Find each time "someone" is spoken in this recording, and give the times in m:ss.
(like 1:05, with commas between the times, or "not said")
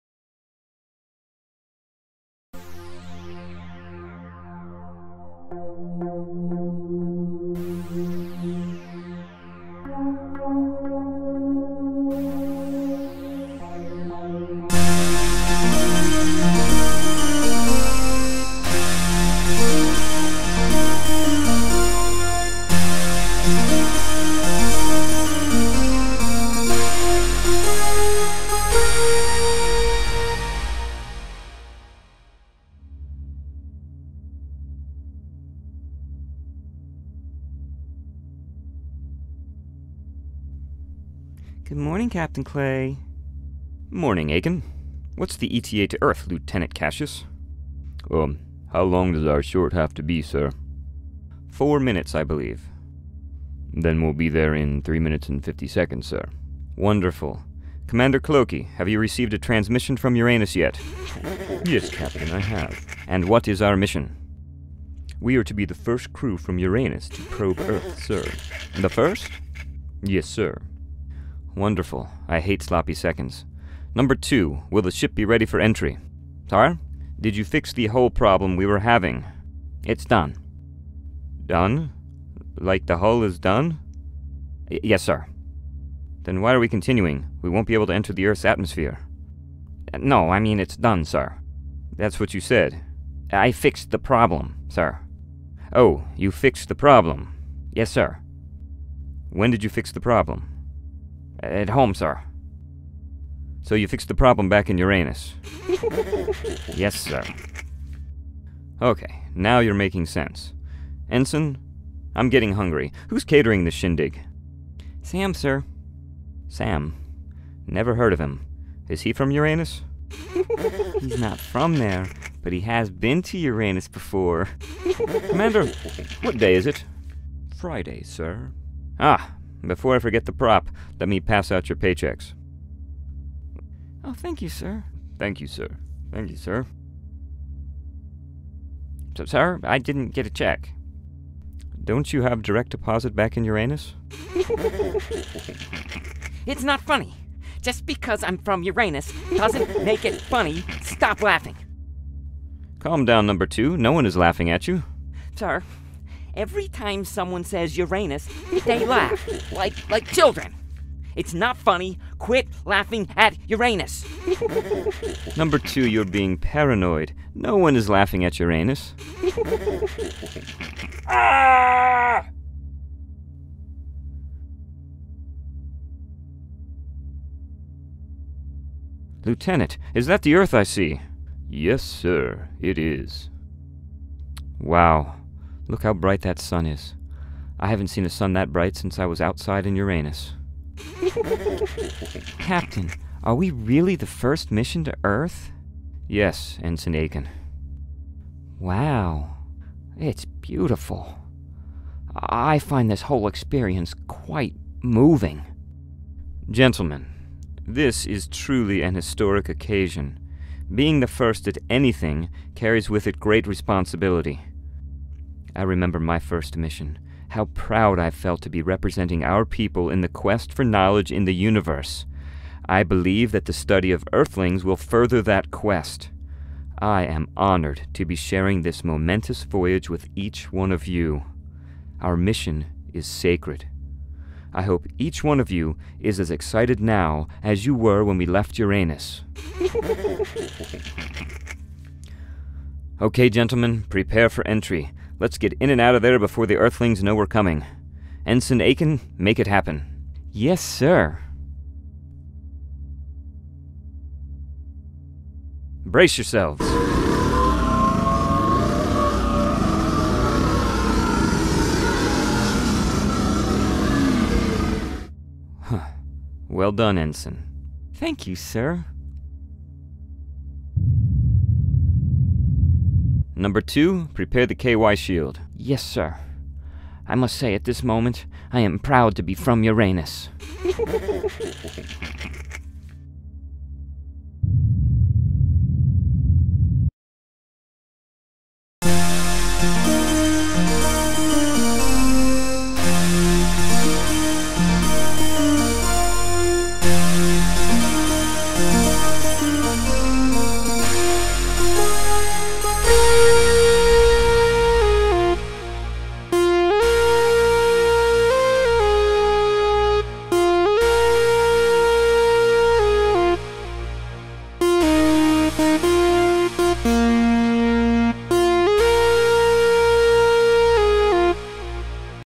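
2:37.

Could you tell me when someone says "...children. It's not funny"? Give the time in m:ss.
2:40.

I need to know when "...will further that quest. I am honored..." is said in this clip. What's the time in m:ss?
3:44.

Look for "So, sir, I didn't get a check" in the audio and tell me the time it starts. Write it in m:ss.
2:19.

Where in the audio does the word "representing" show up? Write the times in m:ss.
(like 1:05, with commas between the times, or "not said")
3:38.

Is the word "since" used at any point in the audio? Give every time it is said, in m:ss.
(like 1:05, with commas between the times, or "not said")
3:08.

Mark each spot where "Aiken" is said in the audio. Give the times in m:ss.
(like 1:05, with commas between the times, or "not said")
0:44, 3:16, 4:08.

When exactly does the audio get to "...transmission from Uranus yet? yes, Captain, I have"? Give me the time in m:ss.
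0:59.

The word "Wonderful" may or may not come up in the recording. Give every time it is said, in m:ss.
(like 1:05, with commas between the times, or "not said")
0:56, 1:11.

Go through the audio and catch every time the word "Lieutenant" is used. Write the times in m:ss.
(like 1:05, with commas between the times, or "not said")
0:46, 2:59.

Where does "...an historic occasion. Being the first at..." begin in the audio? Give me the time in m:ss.
3:28.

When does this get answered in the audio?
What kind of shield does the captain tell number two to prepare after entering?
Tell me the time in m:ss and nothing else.
4:34.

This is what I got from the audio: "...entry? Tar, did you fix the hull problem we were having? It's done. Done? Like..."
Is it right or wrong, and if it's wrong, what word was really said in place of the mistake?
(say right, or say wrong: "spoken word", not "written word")
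right.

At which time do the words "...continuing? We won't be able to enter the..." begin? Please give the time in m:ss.
1:26.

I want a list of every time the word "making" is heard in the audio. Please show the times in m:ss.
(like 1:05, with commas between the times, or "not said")
1:49.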